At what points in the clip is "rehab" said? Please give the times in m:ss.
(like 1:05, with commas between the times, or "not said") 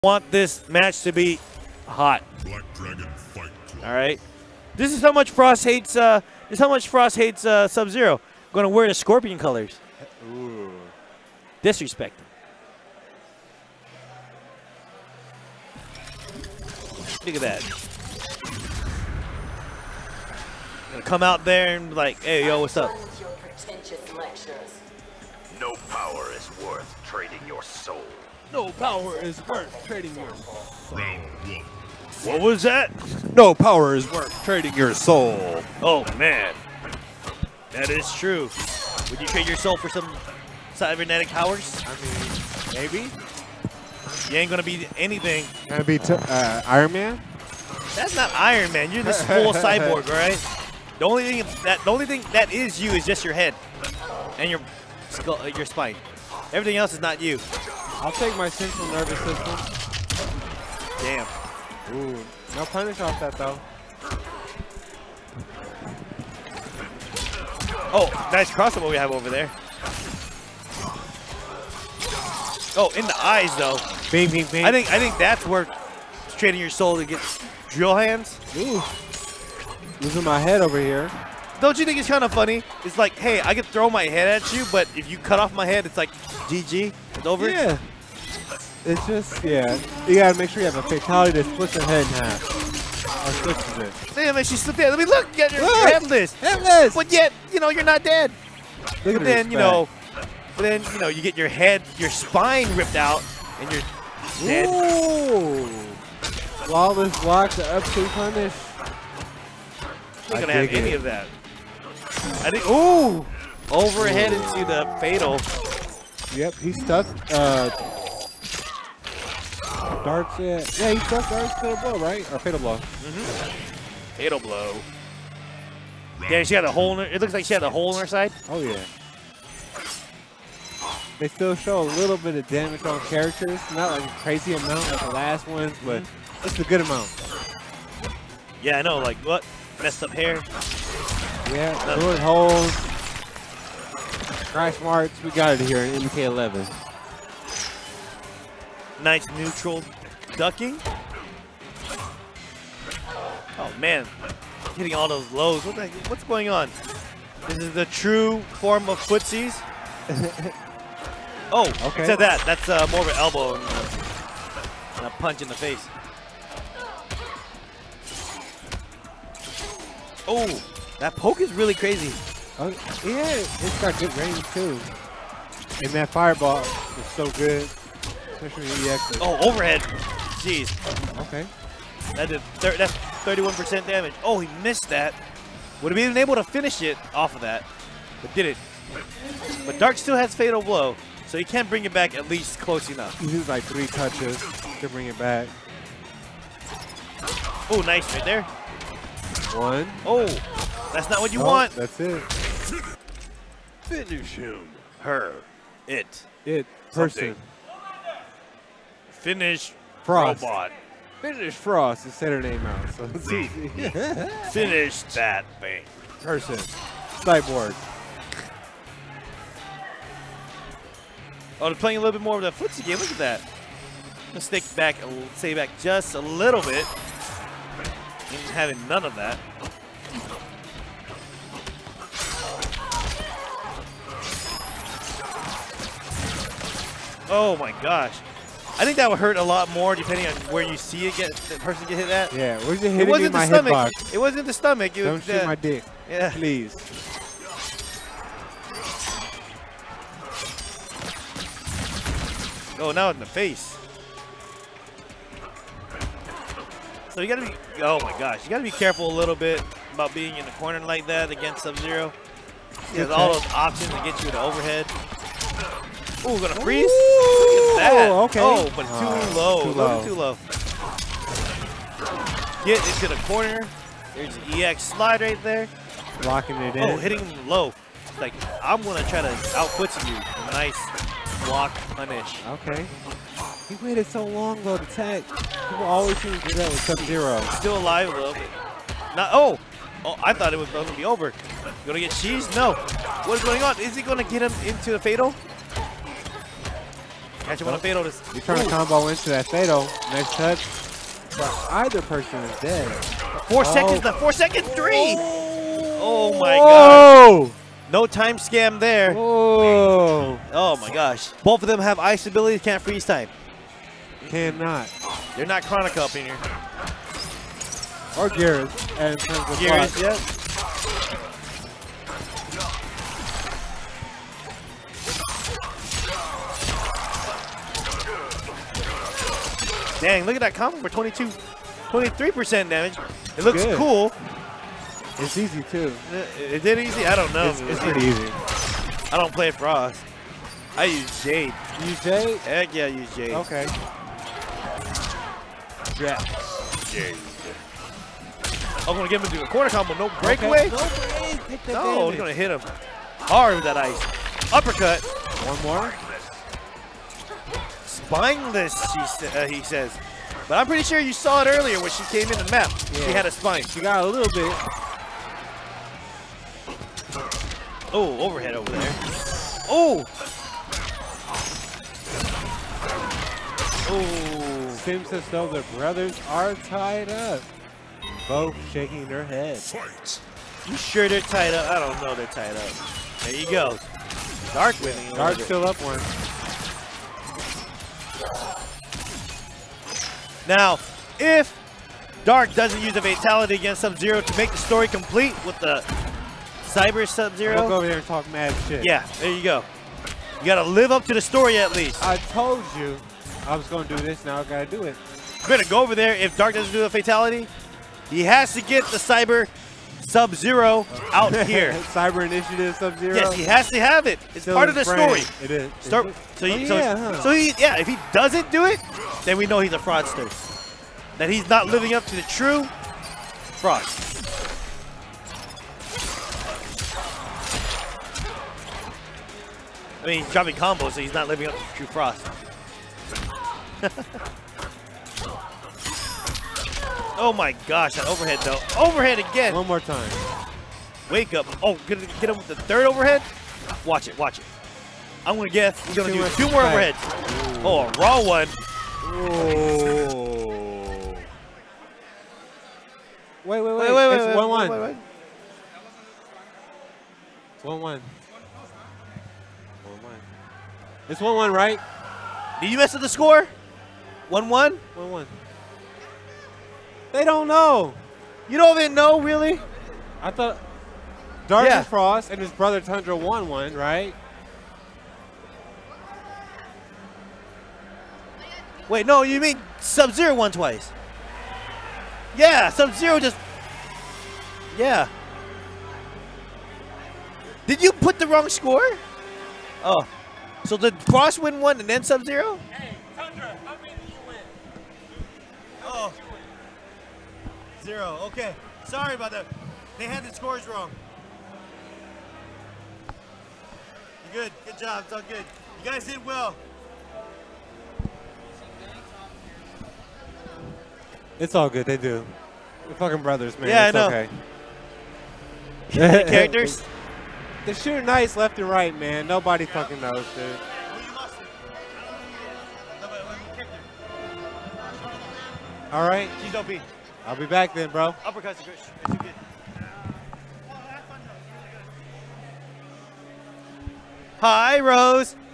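not said.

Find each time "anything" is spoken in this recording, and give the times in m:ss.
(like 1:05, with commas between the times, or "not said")
0:44.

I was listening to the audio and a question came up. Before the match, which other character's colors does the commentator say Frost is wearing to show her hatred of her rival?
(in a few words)
Scorpion.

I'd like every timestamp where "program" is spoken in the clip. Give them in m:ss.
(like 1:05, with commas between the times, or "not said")
not said.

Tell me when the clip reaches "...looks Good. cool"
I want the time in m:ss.
5:33.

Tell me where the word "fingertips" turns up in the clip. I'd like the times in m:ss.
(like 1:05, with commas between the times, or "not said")
not said.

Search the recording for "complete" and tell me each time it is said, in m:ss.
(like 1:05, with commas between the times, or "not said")
6:34.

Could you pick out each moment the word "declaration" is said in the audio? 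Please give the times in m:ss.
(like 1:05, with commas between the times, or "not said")
not said.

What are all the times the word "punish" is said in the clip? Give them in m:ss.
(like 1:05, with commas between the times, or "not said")
1:02, 1:48, 4:41.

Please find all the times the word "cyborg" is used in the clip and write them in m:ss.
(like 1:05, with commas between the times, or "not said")
0:49, 3:36.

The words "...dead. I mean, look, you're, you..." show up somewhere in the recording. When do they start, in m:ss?
1:34.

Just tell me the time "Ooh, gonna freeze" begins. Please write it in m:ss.
4:26.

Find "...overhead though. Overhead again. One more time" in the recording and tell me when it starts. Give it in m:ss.
7:18.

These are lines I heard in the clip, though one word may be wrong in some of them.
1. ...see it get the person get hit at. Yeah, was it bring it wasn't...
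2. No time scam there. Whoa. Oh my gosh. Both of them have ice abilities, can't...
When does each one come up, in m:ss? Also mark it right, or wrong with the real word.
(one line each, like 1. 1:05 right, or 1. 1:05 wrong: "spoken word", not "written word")
1. 4:00 wrong: "hitting", not "bring"
2. 5:07 right.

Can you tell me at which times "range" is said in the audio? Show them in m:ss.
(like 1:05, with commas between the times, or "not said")
2:54.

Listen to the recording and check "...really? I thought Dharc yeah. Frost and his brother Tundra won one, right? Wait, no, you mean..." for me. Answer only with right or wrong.
right.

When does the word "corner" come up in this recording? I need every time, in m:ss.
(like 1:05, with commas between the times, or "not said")
4:20, 4:33, 5:49.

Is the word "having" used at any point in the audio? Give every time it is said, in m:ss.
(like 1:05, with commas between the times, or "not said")
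3:48.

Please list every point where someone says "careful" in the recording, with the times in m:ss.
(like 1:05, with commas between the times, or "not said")
4:18.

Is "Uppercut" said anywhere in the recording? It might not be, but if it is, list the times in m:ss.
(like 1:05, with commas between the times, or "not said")
5:54, 8:48.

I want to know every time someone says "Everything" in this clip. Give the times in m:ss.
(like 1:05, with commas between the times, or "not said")
0:56.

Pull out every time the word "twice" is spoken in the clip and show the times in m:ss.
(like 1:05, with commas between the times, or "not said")
8:00.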